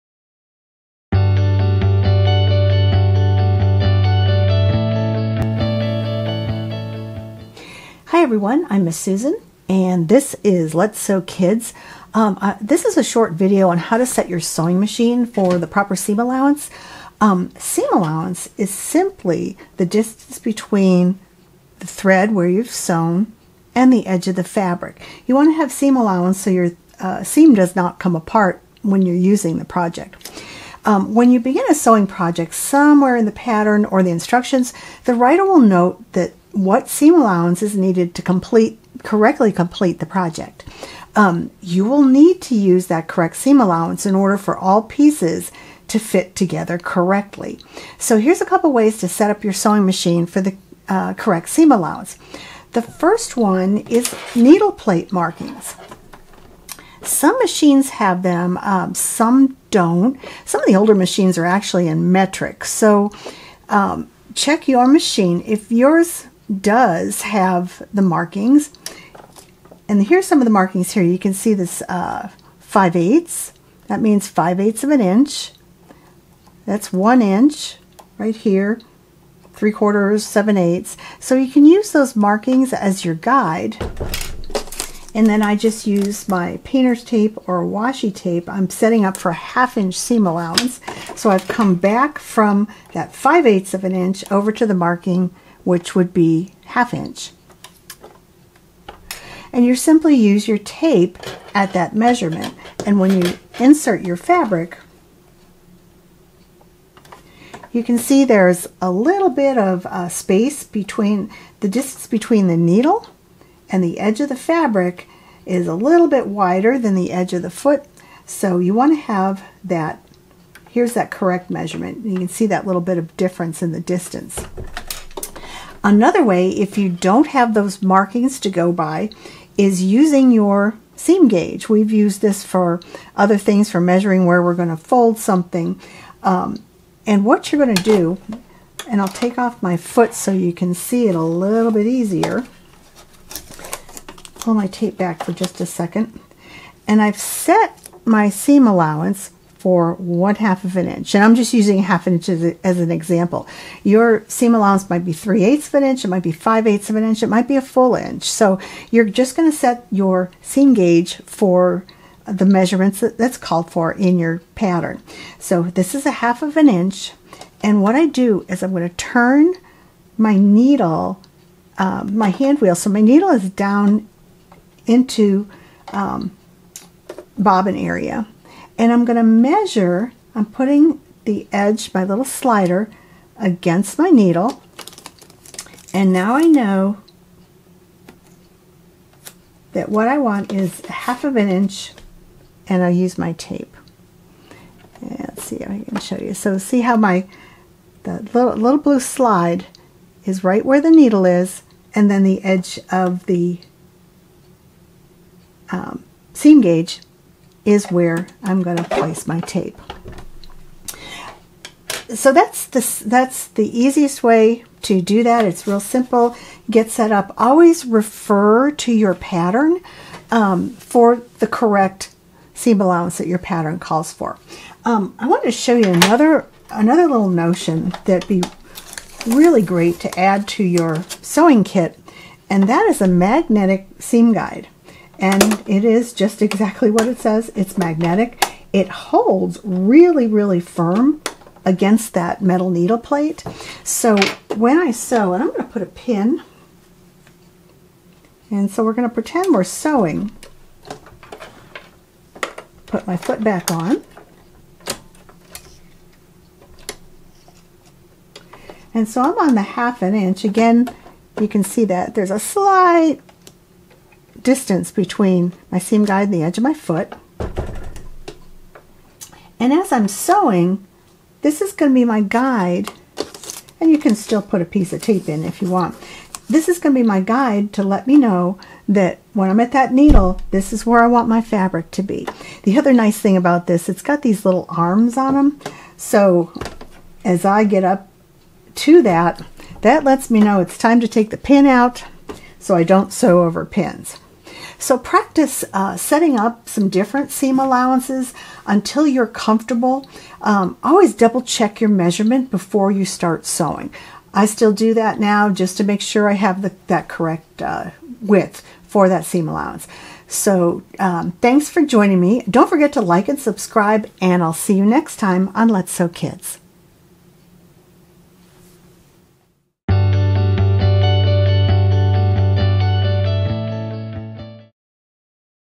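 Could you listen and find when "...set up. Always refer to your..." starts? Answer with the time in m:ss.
3:36.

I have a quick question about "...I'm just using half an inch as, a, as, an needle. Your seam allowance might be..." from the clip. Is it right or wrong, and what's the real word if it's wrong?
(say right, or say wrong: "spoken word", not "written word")
wrong: "example", not "needle".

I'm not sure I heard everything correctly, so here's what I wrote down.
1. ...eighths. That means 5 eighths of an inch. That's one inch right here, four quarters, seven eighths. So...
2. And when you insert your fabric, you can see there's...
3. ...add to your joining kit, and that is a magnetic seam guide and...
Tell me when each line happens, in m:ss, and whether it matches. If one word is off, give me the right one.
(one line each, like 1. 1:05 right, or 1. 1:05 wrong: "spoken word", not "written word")
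1. 1:12 wrong: "three", not "four"
2. 1:42 right
3. 3:50 wrong: "sewing", not "joining".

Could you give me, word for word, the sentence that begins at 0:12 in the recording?
Um, this is a short video on how to set your sewing machine for the proper seam allowance.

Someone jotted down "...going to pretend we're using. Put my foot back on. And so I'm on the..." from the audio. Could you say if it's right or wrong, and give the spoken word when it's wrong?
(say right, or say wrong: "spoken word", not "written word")
wrong: "sewing", not "using".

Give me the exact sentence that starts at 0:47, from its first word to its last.
So here's a couple ways to set up your sewing machine for the uh, correct seam allowance.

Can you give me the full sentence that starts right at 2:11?
We've used this for other things, for measuring where we're going to fold something.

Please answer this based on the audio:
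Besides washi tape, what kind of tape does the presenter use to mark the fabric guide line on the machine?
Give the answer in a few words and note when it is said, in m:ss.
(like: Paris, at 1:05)
painter's tape, at 1:26.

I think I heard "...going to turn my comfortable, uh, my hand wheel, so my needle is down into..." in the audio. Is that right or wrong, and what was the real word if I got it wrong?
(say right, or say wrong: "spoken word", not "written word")
wrong: "needle", not "comfortable".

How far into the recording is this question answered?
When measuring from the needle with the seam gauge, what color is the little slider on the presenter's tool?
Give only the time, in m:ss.
3:18.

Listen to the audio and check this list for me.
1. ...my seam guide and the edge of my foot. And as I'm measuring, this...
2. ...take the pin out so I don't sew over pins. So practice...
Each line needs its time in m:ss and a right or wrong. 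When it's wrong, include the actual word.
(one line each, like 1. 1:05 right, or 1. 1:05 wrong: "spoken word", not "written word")
1. 4:25 wrong: "sewing", not "measuring"
2. 4:51 right.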